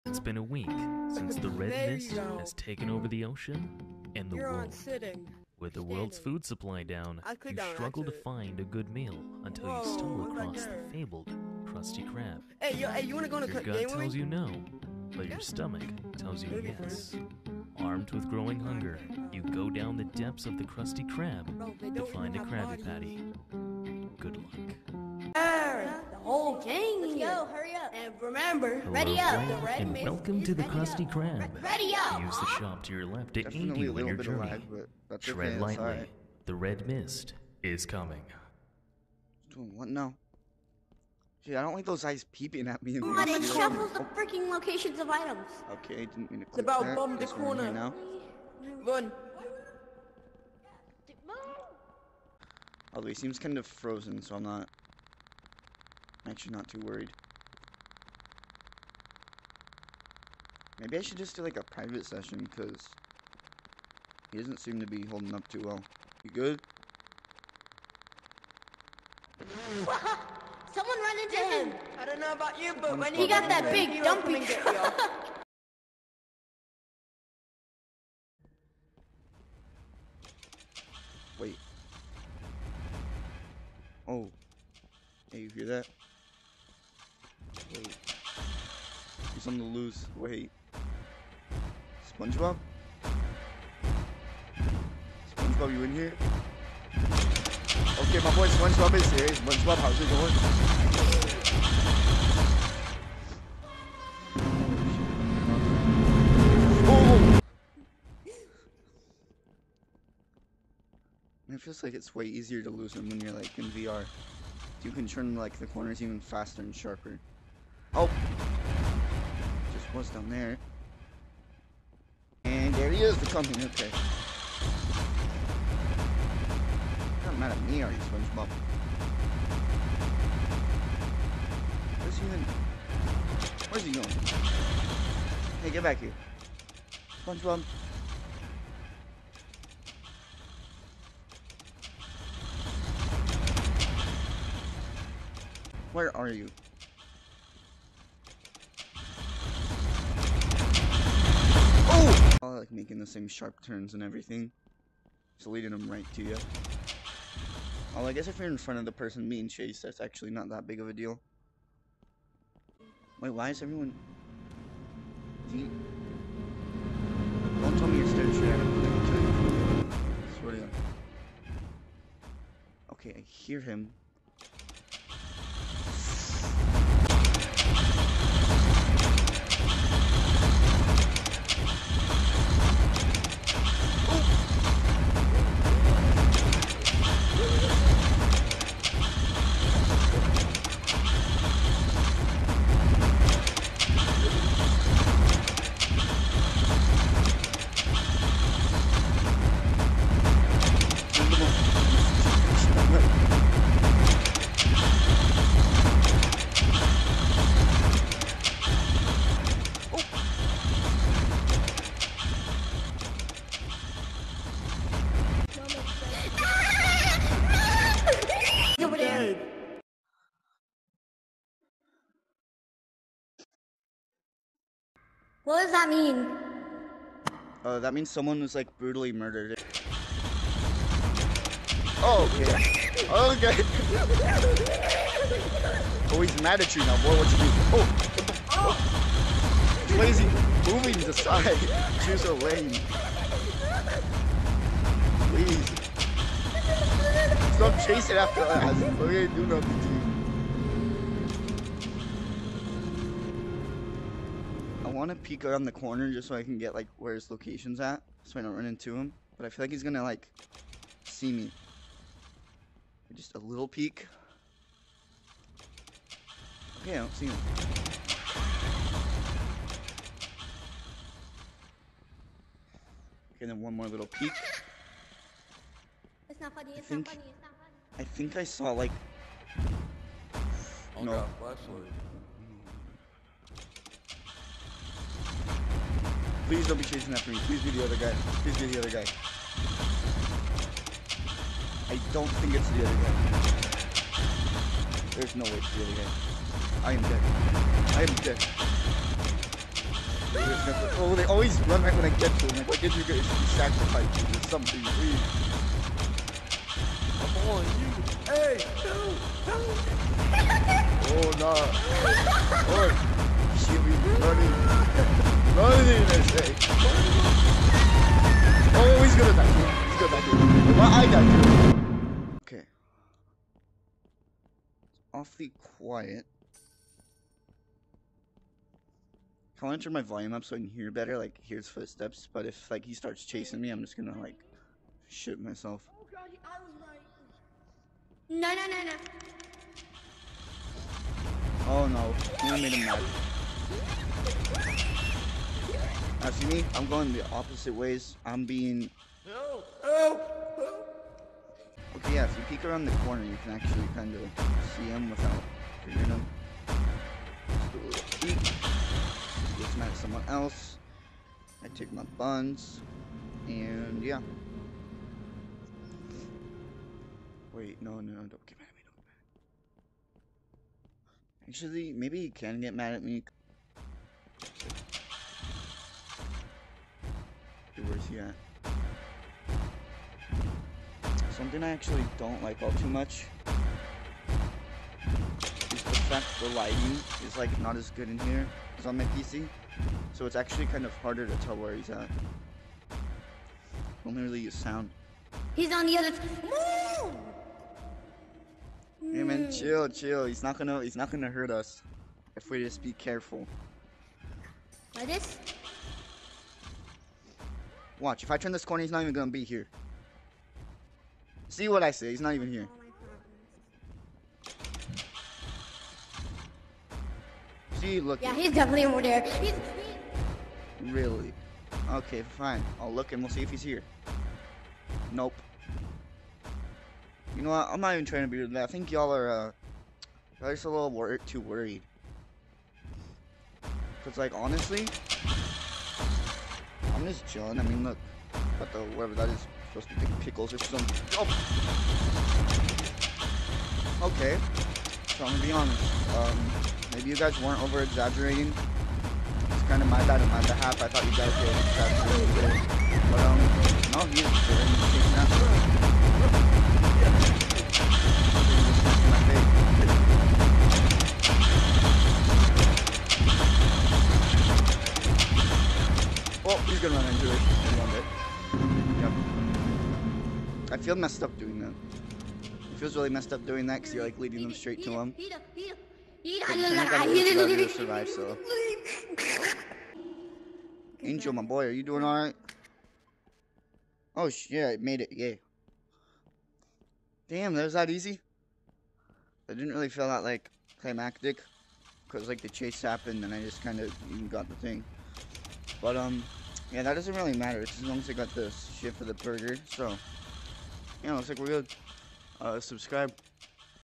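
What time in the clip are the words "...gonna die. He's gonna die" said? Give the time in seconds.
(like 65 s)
319 s.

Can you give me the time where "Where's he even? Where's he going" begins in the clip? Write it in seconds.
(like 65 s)
131 s.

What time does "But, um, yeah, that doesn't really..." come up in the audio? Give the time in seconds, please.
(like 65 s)
495 s.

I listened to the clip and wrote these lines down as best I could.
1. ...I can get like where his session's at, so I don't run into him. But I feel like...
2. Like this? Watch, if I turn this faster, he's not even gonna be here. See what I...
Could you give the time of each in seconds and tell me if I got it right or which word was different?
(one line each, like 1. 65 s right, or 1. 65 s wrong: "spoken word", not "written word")
1. 256 s wrong: "location", not "session"
2. 404 s wrong: "corner", not "faster".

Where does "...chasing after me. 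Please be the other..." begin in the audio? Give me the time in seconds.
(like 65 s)
286 s.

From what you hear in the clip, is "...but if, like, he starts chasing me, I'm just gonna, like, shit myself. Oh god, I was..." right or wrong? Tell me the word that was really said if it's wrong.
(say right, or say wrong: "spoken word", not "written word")
right.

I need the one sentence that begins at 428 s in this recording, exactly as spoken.
I think y'all are, uh, just a little wor too worried.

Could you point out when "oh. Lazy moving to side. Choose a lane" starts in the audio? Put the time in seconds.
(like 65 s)
238 s.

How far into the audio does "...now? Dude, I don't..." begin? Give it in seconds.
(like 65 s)
39 s.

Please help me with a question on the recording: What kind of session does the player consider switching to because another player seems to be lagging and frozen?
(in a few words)
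Private session.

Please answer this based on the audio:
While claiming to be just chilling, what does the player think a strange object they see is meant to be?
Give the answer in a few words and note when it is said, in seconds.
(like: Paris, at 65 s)
Pickles, at 440 s.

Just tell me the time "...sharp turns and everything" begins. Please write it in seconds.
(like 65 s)
153 s.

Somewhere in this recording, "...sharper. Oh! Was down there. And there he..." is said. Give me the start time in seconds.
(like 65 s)
116 s.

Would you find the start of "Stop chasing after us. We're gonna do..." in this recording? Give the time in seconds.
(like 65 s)
247 s.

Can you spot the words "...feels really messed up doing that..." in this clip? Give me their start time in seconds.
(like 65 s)
472 s.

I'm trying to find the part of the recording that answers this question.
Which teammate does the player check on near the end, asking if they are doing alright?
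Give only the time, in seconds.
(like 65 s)
481 s.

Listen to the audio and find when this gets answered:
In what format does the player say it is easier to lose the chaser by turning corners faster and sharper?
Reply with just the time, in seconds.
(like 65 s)
113 s.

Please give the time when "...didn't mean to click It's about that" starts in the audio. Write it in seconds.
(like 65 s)
46 s.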